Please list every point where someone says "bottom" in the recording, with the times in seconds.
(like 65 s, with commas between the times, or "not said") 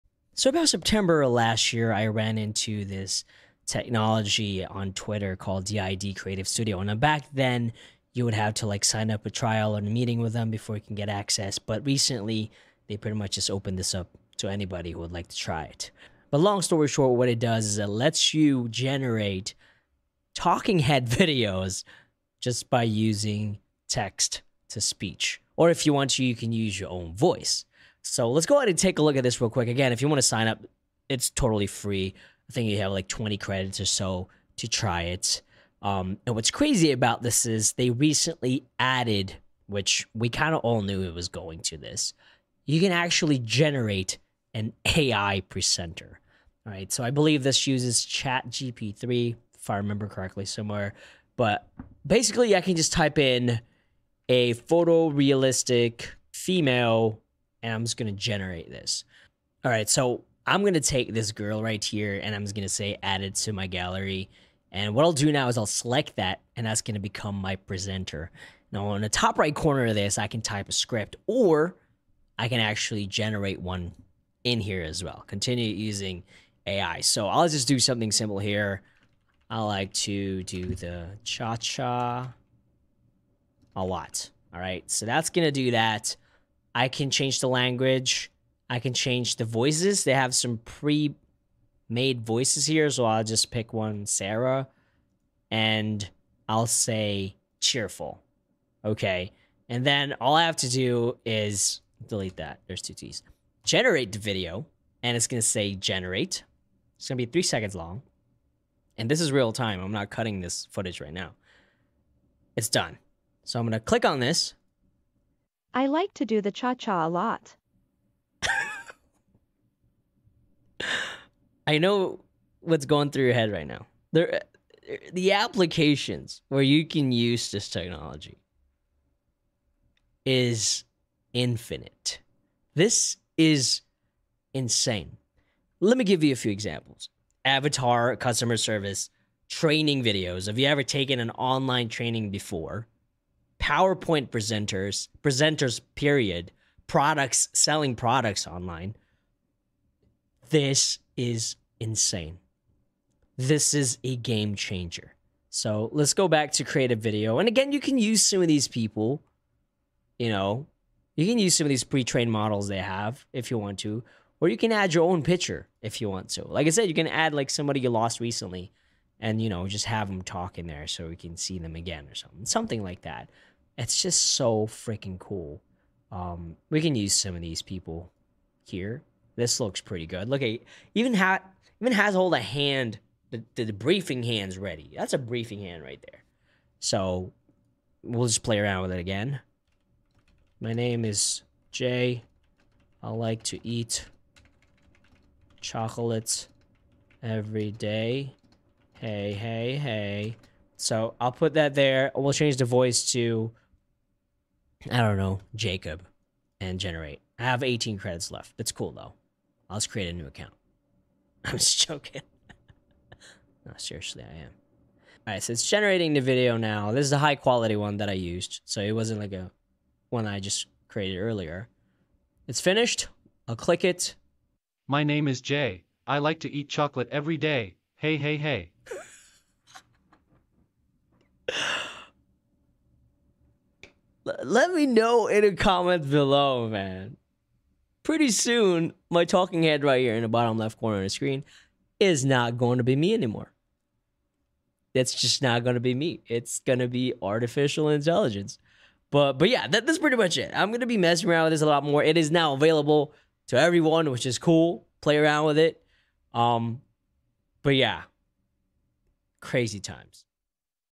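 240 s.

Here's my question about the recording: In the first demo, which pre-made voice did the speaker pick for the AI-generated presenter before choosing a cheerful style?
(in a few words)
Sarah.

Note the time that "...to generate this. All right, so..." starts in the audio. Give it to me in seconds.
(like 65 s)
58 s.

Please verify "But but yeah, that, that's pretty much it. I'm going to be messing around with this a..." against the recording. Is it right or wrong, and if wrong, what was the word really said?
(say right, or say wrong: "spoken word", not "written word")
right.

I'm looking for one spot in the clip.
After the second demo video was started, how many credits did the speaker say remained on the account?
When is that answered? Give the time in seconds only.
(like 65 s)
207 s.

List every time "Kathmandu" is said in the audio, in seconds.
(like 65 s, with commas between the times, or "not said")
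not said.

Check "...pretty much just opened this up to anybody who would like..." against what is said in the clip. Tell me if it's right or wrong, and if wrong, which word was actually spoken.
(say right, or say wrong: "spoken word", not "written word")
right.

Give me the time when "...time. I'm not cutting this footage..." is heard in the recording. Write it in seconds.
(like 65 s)
109 s.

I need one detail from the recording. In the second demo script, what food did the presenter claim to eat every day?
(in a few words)
Chocolate.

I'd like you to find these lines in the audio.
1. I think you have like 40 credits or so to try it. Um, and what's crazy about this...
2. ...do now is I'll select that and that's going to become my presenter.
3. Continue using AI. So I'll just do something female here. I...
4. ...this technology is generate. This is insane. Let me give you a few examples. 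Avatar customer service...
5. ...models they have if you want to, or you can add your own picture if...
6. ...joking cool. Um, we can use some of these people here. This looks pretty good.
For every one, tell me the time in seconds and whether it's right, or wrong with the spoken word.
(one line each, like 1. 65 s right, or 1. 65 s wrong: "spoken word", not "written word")
1. 32 s wrong: "20", not "40"
2. 65 s right
3. 75 s wrong: "simple", not "female"
4. 127 s wrong: "infinite", not "generate"
5. 162 s right
6. 174 s wrong: "freaking", not "joking".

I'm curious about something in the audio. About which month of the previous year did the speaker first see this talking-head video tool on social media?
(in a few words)
September.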